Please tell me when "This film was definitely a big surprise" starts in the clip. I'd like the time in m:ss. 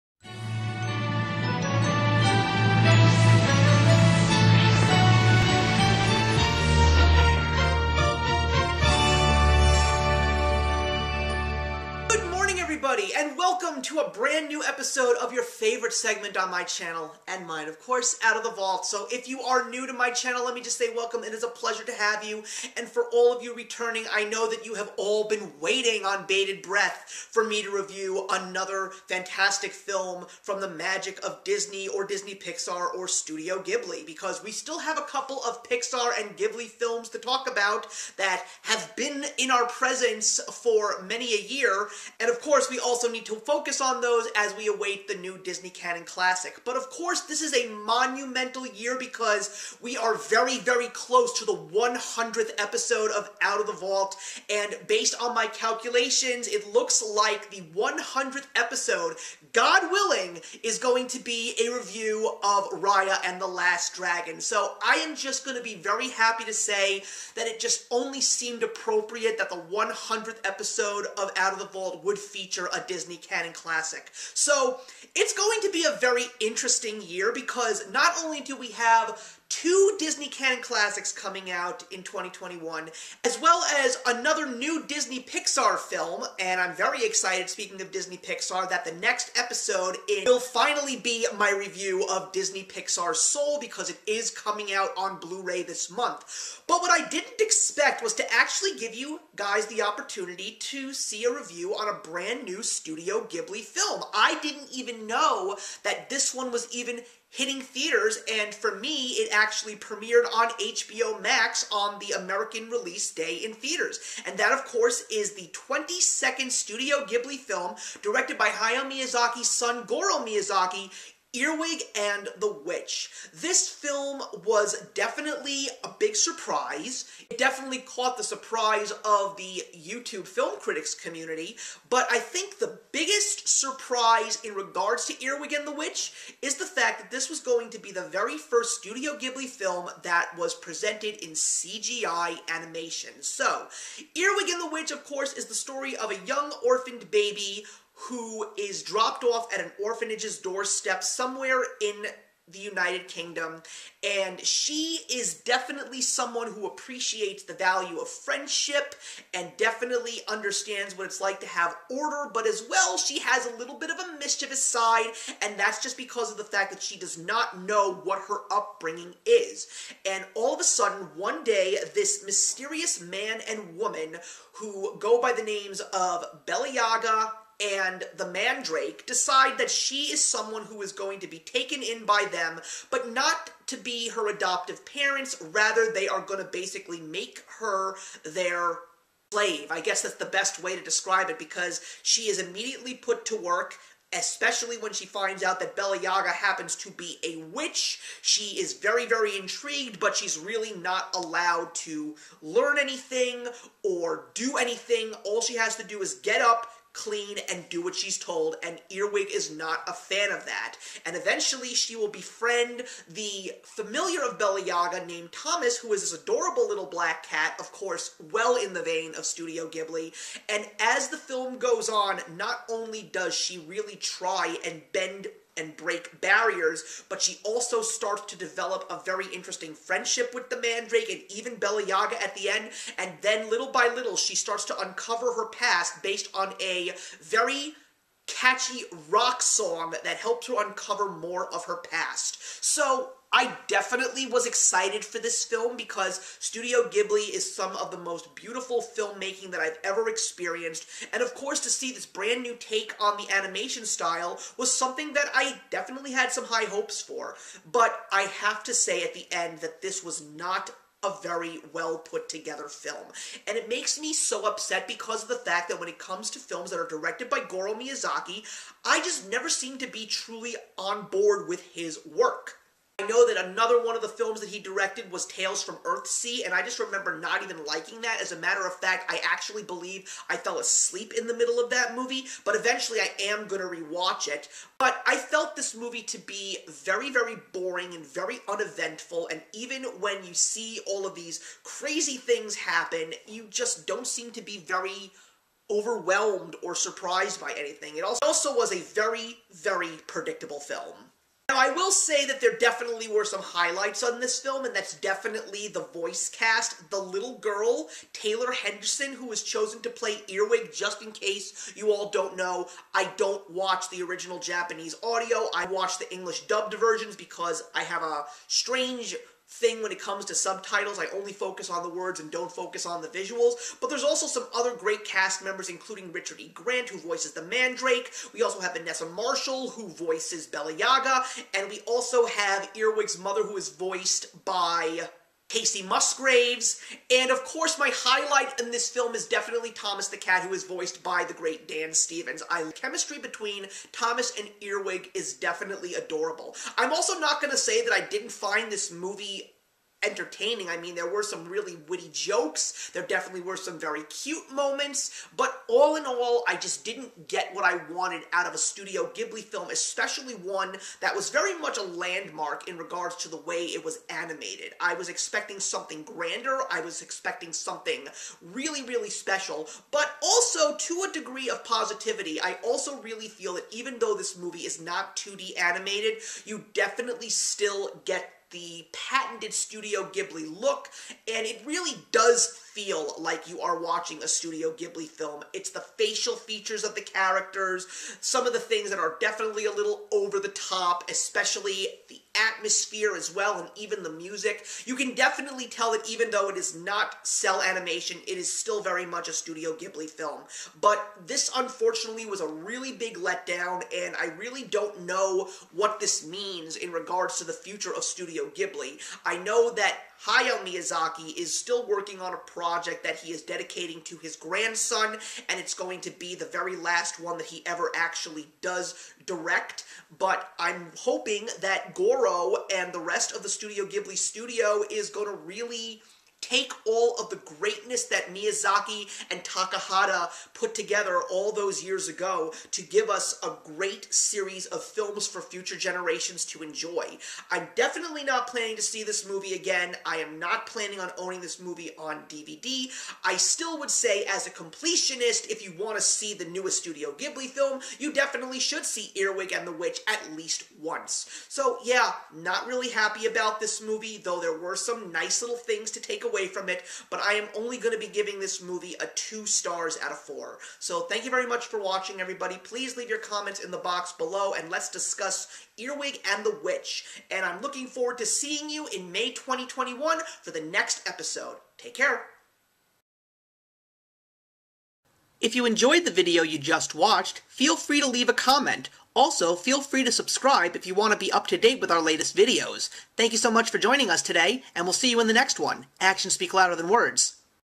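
2:03.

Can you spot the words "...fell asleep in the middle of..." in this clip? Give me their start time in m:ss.
4:40.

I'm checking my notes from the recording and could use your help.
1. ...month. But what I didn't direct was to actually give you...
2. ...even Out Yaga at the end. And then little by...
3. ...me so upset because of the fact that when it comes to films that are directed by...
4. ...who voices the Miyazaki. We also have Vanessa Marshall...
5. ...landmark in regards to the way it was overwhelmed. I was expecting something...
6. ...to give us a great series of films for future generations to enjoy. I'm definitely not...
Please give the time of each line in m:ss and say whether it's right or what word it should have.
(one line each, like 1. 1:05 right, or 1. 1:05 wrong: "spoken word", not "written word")
1. 1:35 wrong: "expect", not "direct"
2. 3:51 wrong: "Bella", not "Out"
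3. 4:23 right
4. 5:26 wrong: "Mandrake", not "Miyazaki"
5. 6:01 wrong: "animated", not "overwhelmed"
6. 7:12 right.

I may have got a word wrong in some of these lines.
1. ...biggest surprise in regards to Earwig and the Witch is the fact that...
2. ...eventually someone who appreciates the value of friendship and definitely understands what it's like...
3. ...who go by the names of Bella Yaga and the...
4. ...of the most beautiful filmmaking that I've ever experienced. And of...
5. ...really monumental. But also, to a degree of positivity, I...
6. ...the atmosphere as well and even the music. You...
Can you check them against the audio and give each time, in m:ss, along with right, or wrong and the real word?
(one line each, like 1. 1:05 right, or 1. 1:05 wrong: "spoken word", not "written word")
1. 2:12 right
2. 2:35 wrong: "definitely", not "eventually"
3. 2:54 right
4. 4:07 right
5. 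6:08 wrong: "special", not "monumental"
6. 6:32 right.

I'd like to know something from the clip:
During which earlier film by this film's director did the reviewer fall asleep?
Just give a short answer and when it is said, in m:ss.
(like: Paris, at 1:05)
Tales from Earthsea, at 4:35.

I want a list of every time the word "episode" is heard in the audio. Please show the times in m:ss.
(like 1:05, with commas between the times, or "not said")
0:14, 0:52, 0:58, 1:10, 1:29, 7:51.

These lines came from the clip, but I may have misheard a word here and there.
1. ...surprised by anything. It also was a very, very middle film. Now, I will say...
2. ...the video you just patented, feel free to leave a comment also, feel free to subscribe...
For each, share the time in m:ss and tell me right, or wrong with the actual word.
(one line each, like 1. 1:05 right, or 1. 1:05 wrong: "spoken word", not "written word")
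1. 4:56 wrong: "predictable", not "middle"
2. 7:56 wrong: "watched", not "patented".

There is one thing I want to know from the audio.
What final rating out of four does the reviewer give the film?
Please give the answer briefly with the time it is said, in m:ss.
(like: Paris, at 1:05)
2 stars, at 7:39.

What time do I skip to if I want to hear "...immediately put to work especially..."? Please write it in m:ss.
3:12.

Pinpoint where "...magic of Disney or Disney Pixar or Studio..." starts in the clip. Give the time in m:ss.
0:30.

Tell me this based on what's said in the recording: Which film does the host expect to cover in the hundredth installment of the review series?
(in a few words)
Raya and the Last Dragon.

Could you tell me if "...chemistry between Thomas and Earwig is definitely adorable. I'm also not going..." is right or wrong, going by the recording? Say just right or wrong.
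right.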